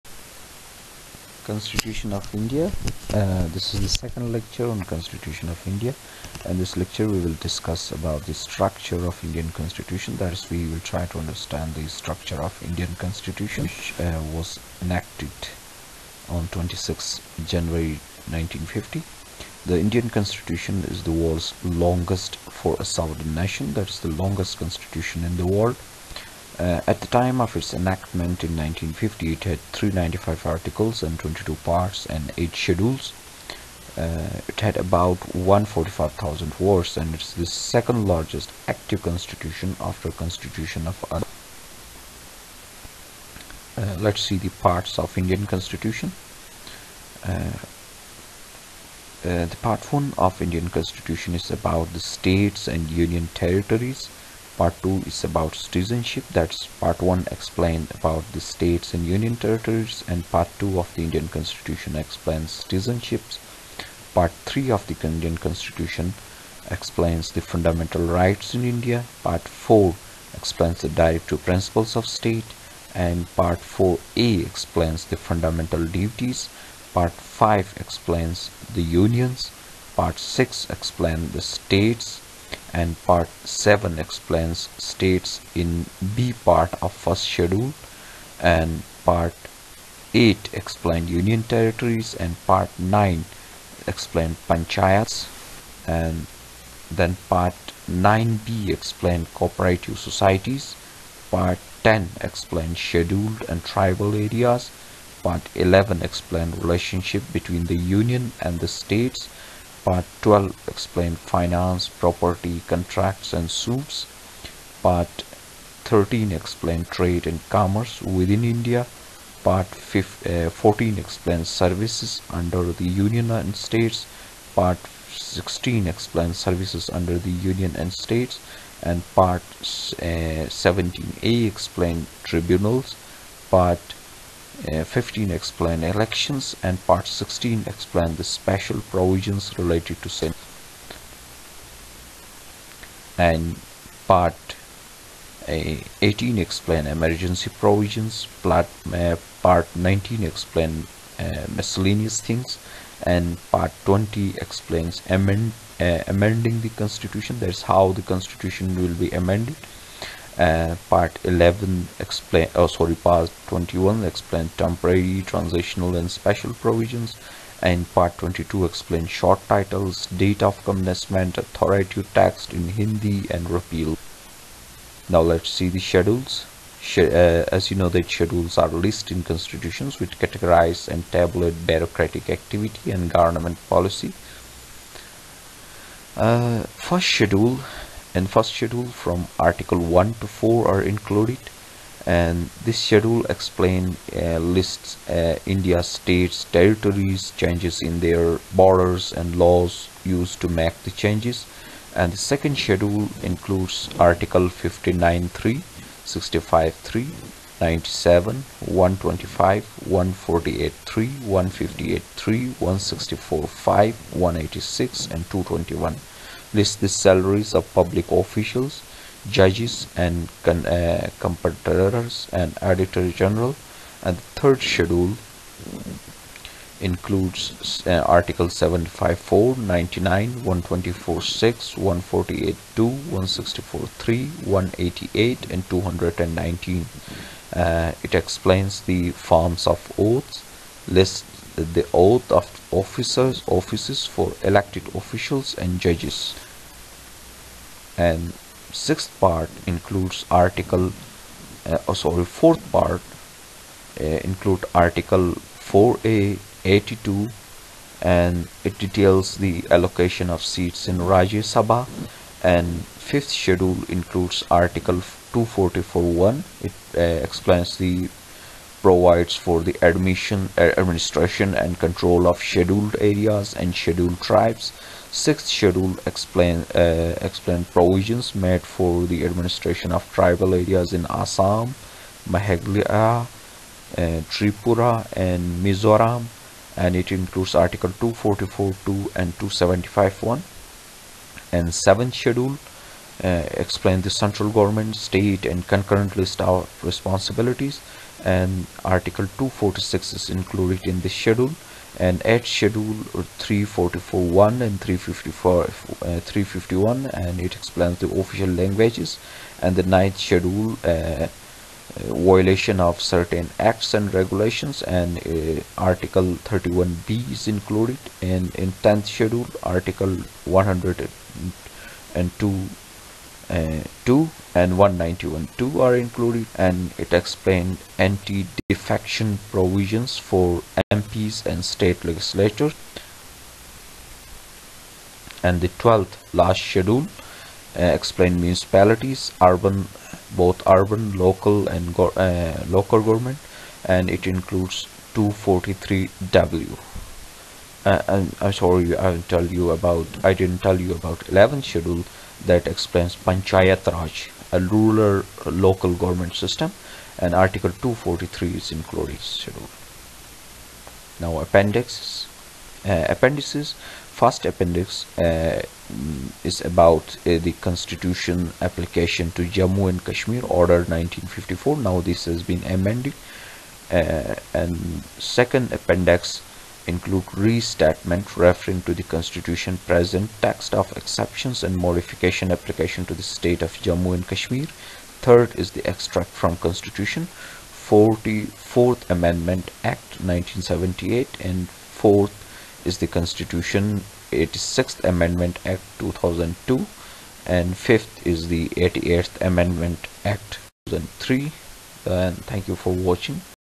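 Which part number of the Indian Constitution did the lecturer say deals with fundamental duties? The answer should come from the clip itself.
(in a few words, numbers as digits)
Part 4A.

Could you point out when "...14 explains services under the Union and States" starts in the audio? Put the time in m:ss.
2:00.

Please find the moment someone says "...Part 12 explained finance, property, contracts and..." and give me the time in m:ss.
1:49.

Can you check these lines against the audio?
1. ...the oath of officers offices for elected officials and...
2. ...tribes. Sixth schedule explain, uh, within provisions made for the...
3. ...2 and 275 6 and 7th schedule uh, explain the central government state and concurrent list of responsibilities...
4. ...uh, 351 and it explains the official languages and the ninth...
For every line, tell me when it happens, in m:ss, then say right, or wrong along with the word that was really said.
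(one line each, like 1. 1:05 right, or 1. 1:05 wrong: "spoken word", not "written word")
1. 4:01 right
2. 4:34 wrong: "explain", not "within"
3. 4:48 wrong: "1", not "6"
4. 5:05 right.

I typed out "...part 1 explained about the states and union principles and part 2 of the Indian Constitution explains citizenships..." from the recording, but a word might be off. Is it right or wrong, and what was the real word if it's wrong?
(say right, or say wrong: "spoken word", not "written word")
wrong: "territories", not "principles".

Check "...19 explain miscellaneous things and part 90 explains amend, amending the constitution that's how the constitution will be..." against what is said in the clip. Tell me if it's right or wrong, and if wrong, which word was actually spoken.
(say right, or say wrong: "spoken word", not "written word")
wrong: "20", not "90".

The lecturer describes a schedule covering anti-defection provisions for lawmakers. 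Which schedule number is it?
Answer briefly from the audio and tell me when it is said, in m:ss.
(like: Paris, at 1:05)
10th, at 5:18.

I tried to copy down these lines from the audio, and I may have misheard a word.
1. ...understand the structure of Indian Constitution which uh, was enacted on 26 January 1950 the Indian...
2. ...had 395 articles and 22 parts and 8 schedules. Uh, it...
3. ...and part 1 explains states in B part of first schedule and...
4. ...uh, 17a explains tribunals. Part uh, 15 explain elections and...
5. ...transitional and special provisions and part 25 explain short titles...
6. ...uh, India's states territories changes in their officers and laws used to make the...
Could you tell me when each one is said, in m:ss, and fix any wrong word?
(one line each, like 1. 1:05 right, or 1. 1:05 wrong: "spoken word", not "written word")
1. 0:11 right
2. 0:29 right
3. 1:22 wrong: "7", not "1"
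4. 2:09 right
5. 2:45 wrong: "22", not "25"
6. 3:15 wrong: "borders", not "officers".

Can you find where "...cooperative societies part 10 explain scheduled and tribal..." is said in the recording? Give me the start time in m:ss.
1:39.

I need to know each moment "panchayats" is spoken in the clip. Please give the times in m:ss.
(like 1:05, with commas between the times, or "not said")
1:34, 5:53.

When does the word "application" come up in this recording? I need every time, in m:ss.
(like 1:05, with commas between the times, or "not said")
6:08, 6:22.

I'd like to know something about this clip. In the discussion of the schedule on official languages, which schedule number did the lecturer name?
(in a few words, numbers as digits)
8th.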